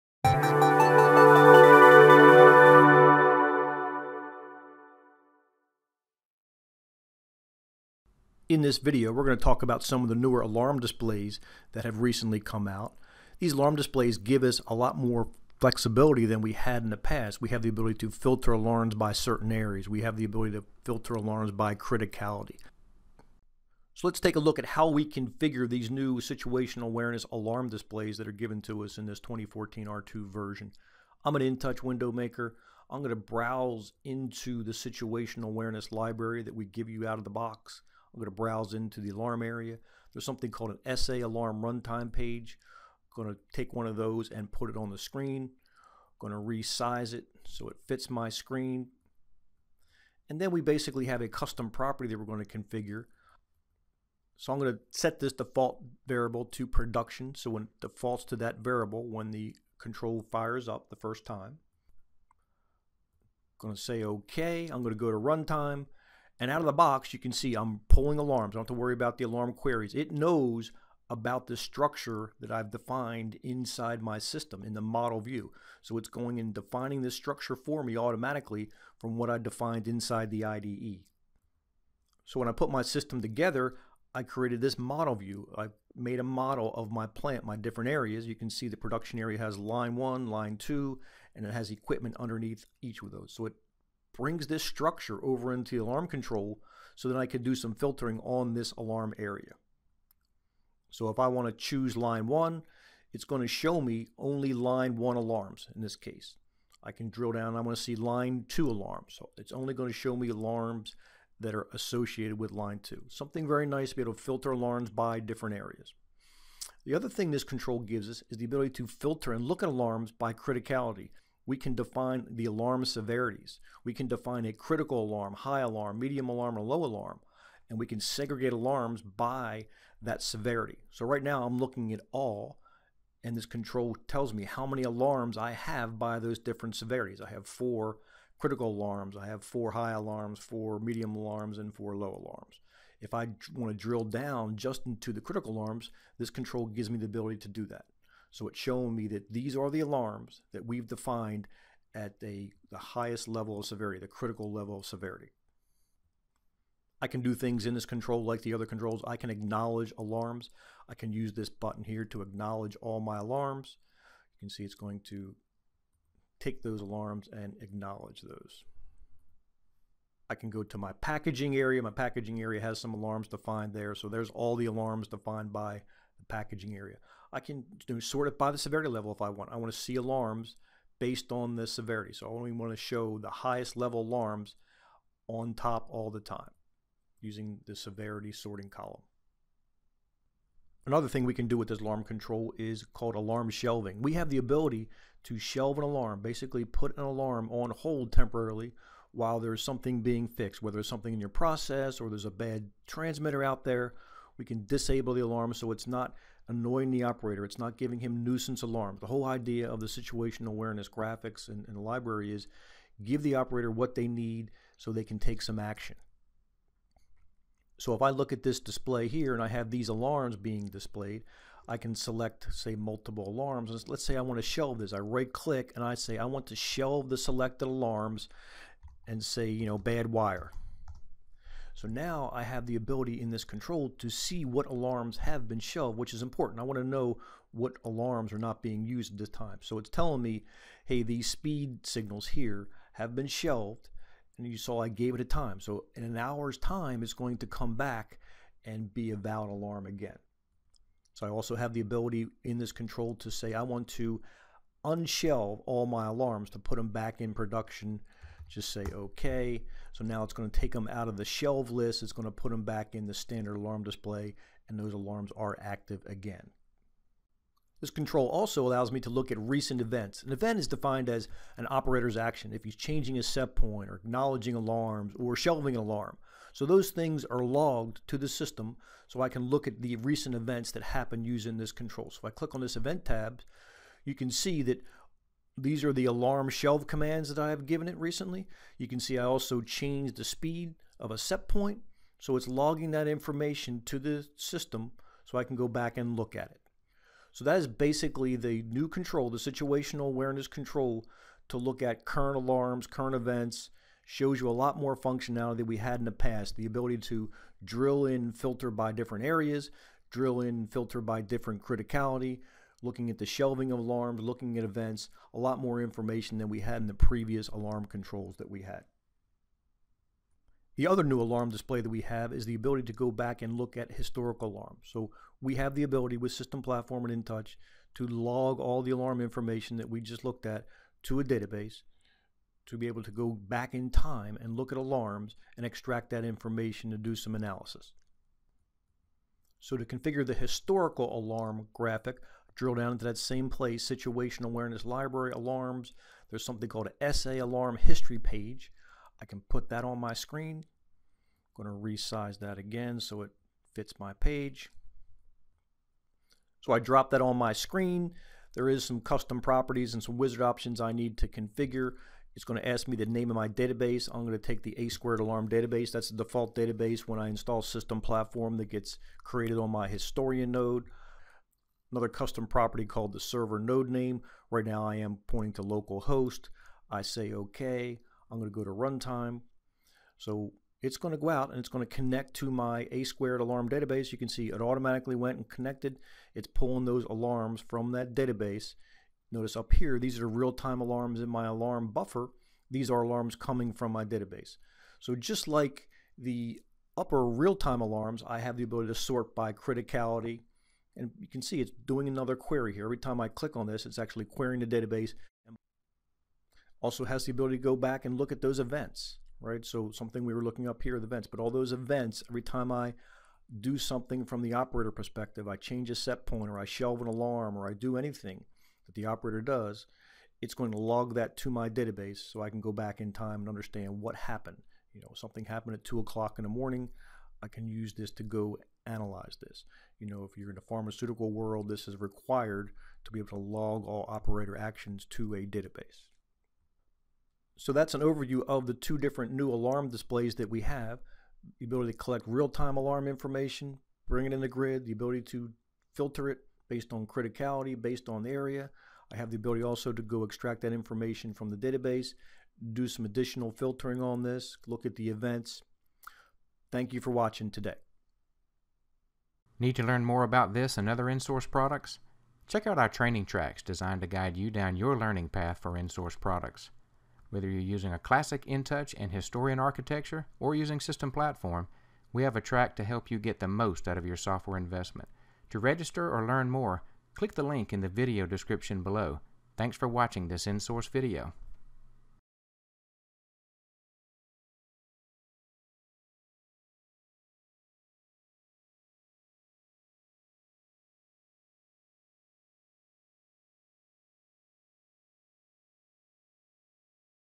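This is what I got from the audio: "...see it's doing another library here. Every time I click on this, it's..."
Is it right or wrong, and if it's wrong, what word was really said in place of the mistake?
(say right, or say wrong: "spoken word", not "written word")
wrong: "query", not "library".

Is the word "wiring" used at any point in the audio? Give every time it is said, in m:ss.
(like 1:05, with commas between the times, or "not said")
not said.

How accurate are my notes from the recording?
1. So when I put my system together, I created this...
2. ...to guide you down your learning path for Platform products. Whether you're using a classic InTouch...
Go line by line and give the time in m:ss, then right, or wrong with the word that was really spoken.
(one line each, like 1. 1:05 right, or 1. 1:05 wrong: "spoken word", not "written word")
1. 1:22 right
2. 7:44 wrong: "InSource", not "Platform".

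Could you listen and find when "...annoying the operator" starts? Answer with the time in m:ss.
3:26.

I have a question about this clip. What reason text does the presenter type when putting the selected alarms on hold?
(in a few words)
bad wire.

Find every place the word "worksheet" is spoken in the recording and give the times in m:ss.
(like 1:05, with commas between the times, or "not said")
not said.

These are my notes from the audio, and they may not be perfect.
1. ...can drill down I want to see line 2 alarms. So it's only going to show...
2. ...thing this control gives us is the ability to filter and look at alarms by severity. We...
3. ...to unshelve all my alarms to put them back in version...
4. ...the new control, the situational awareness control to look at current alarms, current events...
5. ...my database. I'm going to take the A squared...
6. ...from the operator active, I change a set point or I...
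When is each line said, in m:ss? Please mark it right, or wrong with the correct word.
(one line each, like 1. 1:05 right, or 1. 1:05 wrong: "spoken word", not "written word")
1. 1:46 right
2. 1:57 wrong: "criticality", not "severity"
3. 4:13 wrong: "production", not "version"
4. 4:58 right
5. 6:03 right
6. 6:54 wrong: "perspective", not "active".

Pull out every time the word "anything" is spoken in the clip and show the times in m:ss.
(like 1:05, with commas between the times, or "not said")
6:57.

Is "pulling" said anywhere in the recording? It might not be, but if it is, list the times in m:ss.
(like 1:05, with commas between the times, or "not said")
1:07, 6:26.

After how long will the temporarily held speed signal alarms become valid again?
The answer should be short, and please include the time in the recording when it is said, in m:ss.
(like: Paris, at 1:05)
an hour, at 4:06.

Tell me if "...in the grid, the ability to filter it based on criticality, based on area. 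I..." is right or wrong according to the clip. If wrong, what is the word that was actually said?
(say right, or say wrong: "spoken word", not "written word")
right.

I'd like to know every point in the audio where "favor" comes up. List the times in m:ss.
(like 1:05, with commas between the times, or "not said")
not said.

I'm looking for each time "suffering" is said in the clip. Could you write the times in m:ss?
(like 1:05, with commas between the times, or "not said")
not said.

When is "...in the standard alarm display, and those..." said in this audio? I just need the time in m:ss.
4:22.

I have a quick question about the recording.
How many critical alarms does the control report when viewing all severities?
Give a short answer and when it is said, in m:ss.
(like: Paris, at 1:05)
4, at 2:17.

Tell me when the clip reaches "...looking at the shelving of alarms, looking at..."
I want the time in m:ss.
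5:12.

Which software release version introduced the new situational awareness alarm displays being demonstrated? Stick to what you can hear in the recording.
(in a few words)
2014 R2.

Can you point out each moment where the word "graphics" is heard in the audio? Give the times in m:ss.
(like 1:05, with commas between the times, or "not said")
3:30, 5:41.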